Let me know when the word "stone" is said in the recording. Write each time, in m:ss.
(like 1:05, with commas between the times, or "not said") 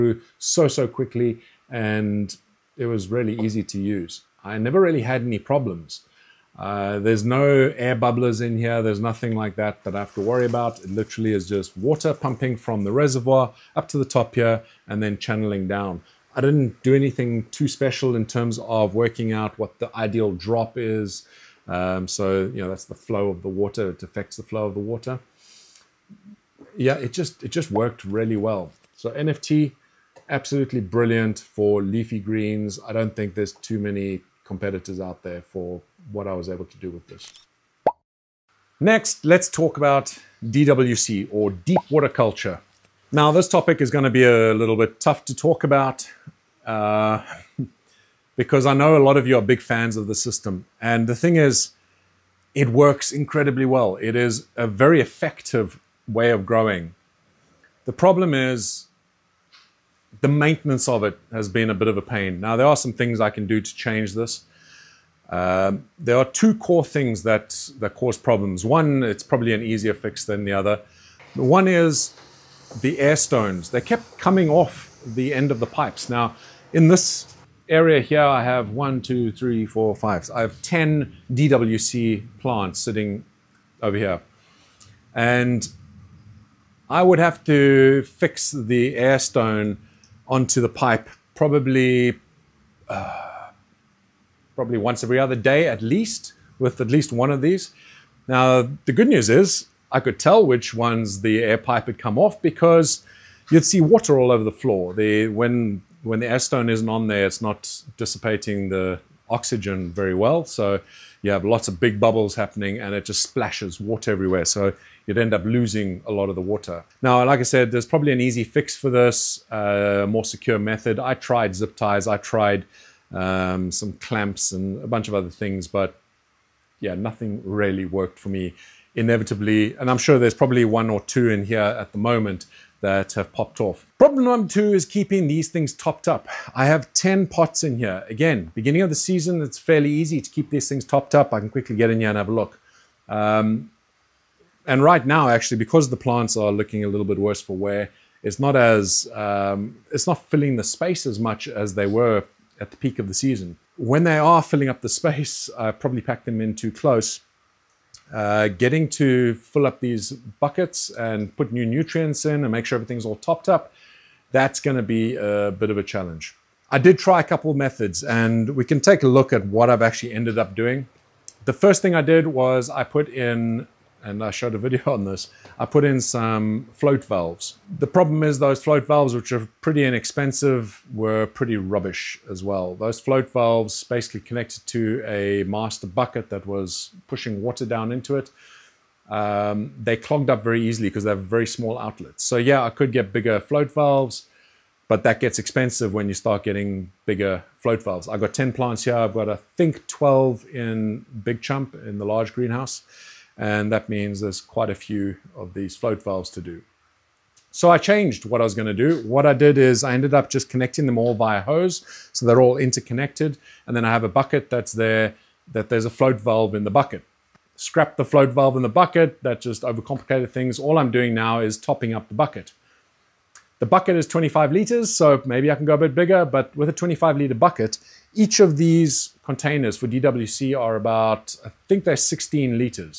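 1:13, 1:29, 1:46.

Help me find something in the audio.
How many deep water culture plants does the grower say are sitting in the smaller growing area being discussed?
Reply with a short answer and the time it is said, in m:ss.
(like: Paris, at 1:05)
10, at 1:20.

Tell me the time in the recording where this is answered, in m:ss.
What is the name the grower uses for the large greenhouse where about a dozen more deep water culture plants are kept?
3:21.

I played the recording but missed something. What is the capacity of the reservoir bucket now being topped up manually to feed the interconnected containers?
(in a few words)
25 liters.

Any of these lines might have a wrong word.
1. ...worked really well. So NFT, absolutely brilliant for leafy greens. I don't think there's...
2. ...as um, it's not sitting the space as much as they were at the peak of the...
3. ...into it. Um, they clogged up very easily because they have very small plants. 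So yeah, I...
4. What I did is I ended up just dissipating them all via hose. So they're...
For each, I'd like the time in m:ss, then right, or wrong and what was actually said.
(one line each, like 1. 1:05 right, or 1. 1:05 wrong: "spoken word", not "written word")
1. 0:27 right
2. 2:28 wrong: "filling", not "sitting"
3. 3:07 wrong: "outlets", not "plants"
4. 3:29 wrong: "connecting", not "dissipating".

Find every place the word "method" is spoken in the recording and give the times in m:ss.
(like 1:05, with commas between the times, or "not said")
2:00, 2:47.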